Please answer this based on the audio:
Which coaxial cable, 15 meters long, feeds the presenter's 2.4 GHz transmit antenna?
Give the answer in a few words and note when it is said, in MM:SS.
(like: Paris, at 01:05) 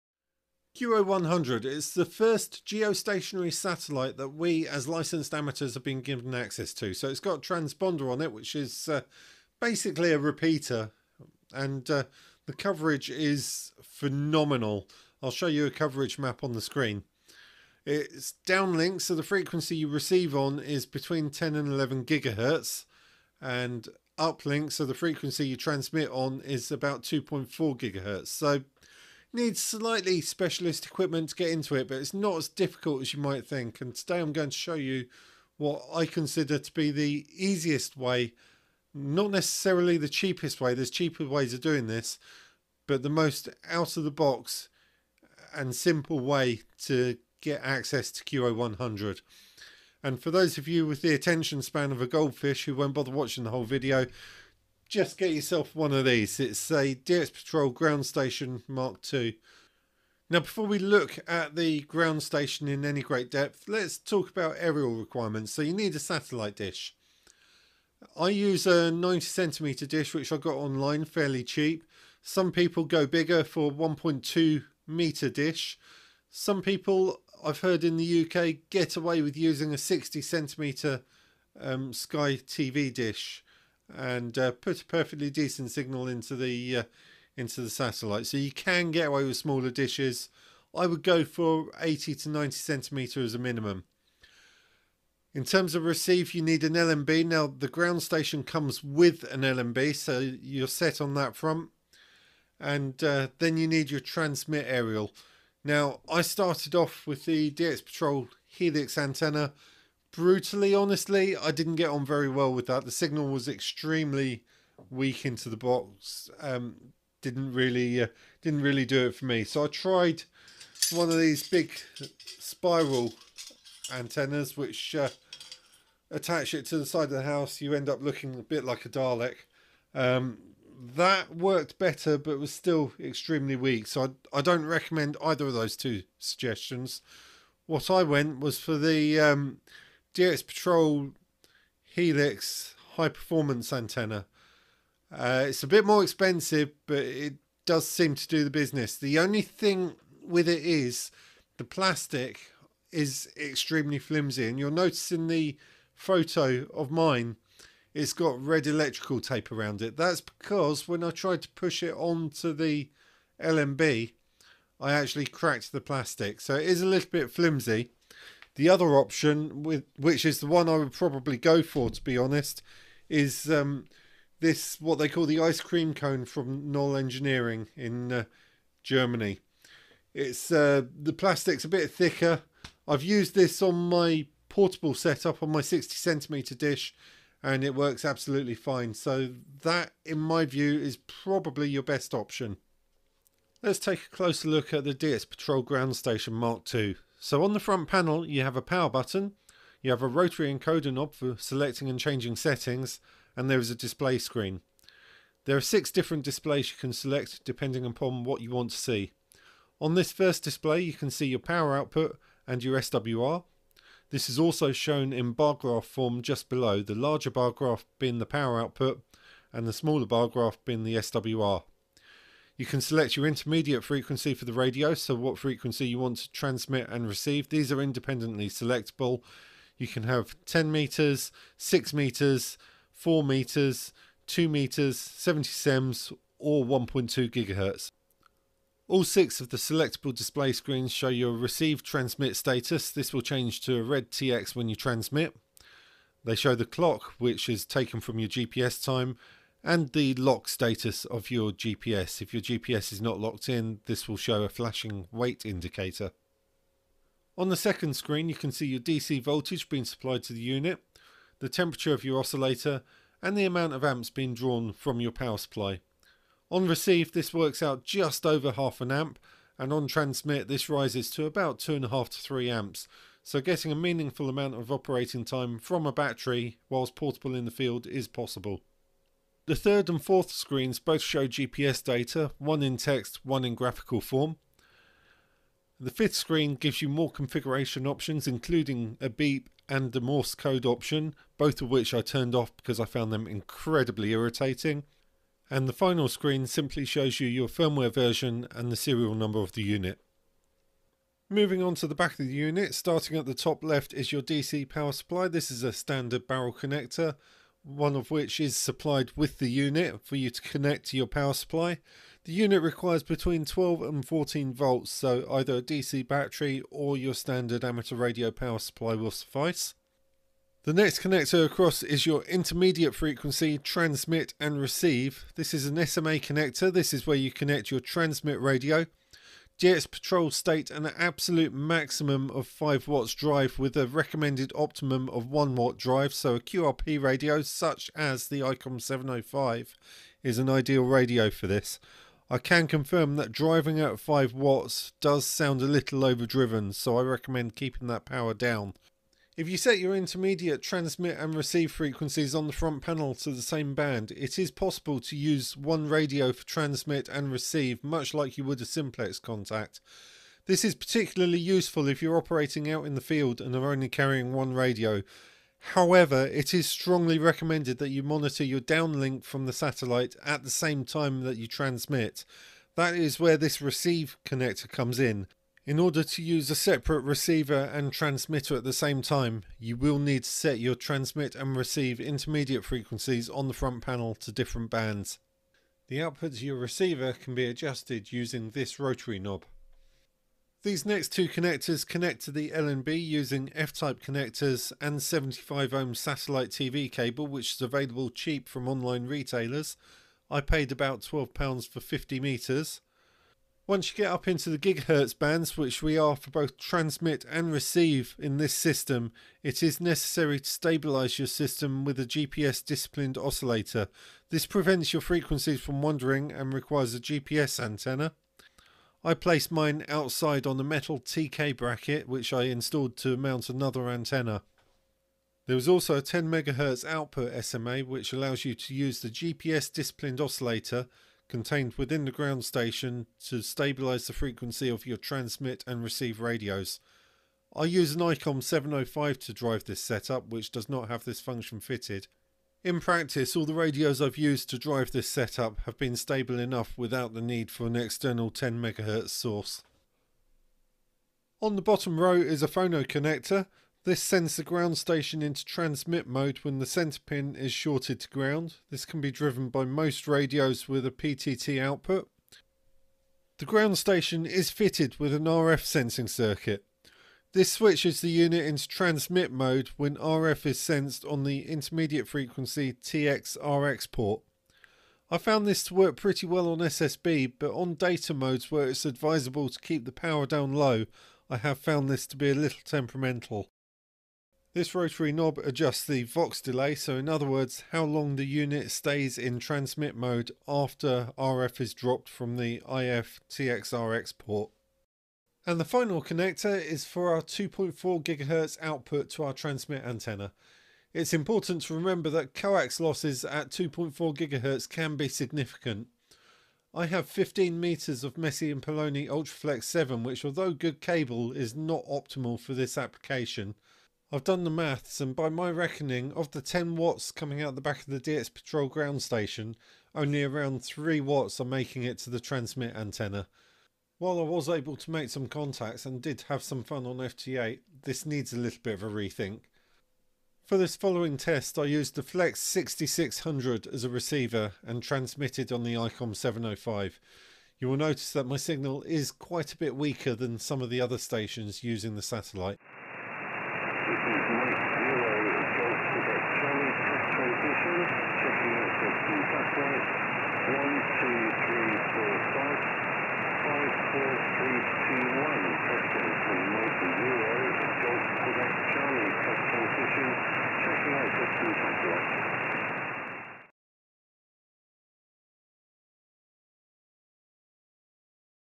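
Messi and Paoloni Ultraflex 7, at 08:28.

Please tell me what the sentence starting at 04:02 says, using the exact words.
This will change to a red TX when you transmit.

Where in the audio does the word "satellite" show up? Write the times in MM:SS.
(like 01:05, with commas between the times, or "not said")
00:03, 01:05, 01:27, 06:09, 06:35, 09:02.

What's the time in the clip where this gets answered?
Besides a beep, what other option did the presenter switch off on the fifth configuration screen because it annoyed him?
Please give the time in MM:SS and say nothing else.
04:49.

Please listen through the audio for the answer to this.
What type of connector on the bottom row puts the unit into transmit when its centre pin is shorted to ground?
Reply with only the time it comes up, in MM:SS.
07:32.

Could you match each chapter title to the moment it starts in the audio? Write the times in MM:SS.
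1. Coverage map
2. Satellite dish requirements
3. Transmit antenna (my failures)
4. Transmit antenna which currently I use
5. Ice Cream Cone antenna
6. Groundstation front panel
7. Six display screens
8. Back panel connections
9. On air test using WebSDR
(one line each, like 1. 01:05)
1. 00:15
2. 01:05
3. 01:45
4. 02:20
5. 02:55
6. 03:15
7. 03:30
8. 05:00
9. 08:50.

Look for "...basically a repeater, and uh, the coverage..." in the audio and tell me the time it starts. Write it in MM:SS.
00:09.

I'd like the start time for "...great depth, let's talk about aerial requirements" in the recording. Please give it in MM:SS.
01:03.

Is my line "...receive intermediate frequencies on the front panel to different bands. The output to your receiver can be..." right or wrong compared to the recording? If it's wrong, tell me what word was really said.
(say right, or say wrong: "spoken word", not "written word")
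right.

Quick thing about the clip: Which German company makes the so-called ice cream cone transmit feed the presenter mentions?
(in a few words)
Knoll Engineering.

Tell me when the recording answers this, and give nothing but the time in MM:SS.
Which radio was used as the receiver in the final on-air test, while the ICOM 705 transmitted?
08:52.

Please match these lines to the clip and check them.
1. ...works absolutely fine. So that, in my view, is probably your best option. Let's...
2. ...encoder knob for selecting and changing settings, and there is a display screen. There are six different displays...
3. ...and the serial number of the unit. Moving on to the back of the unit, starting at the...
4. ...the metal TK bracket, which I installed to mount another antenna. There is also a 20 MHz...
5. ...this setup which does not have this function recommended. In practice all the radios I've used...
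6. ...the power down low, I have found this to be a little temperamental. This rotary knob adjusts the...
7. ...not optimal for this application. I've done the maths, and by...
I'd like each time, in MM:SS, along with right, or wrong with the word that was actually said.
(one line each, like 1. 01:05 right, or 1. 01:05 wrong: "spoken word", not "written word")
1. 03:07 right
2. 03:20 right
3. 04:58 right
4. 07:00 wrong: "10", not "20"
5. 07:19 wrong: "fitted", not "recommended"
6. 07:59 right
7. 08:31 right.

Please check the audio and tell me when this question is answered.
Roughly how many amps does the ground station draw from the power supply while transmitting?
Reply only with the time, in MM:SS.
04:31.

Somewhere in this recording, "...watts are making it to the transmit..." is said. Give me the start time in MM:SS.
08:40.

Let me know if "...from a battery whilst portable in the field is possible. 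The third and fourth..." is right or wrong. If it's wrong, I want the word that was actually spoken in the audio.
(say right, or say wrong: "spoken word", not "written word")
right.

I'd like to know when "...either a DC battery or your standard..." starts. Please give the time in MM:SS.
05:15.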